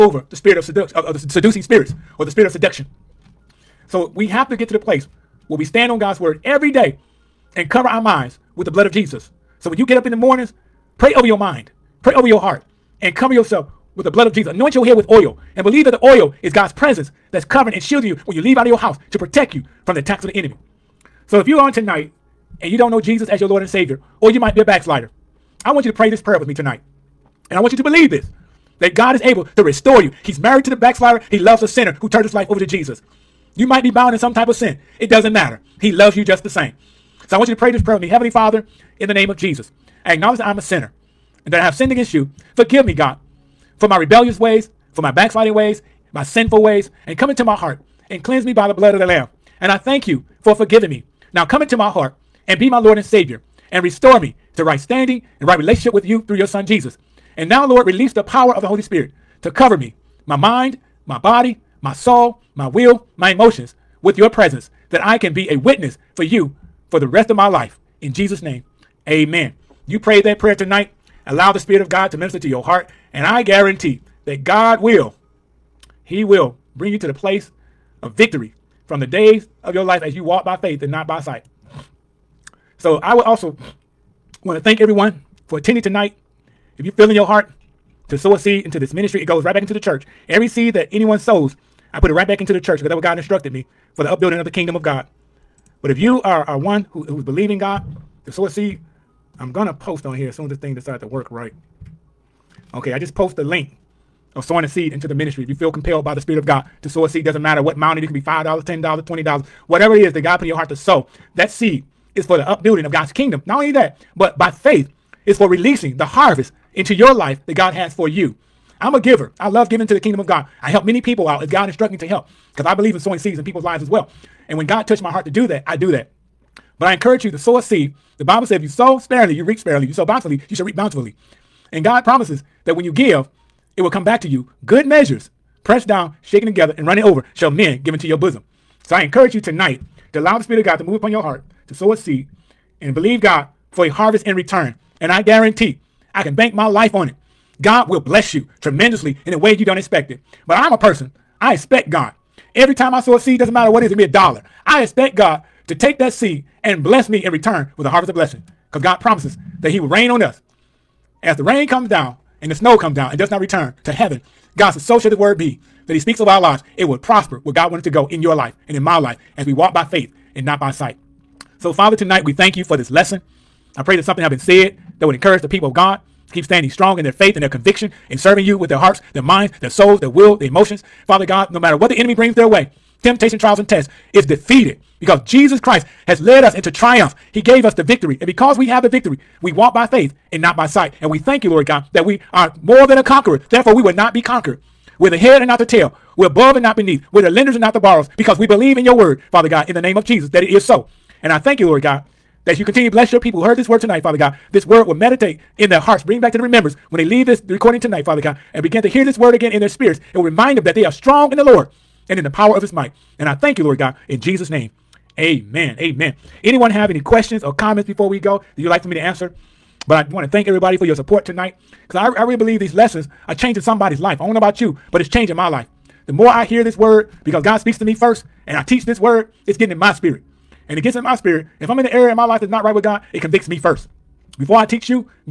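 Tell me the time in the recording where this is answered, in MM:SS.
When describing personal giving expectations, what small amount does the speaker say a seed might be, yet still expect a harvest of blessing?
02:34.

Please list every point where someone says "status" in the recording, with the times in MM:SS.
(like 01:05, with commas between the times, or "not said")
not said.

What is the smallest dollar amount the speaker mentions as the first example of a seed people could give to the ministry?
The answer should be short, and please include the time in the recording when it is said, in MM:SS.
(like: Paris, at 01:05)
$5, at 01:48.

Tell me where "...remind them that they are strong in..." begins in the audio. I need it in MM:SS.
03:30.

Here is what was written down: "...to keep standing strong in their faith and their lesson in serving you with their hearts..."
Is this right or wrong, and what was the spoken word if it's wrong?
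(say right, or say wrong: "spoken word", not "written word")
wrong: "conviction", not "lesson".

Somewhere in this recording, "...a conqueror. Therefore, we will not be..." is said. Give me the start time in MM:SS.
03:12.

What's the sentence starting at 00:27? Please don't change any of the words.
And I want you to believe this that God is able to restore you.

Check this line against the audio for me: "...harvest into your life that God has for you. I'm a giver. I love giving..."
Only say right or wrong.
right.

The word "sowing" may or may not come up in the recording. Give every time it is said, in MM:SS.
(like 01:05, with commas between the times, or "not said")
01:44, 02:02.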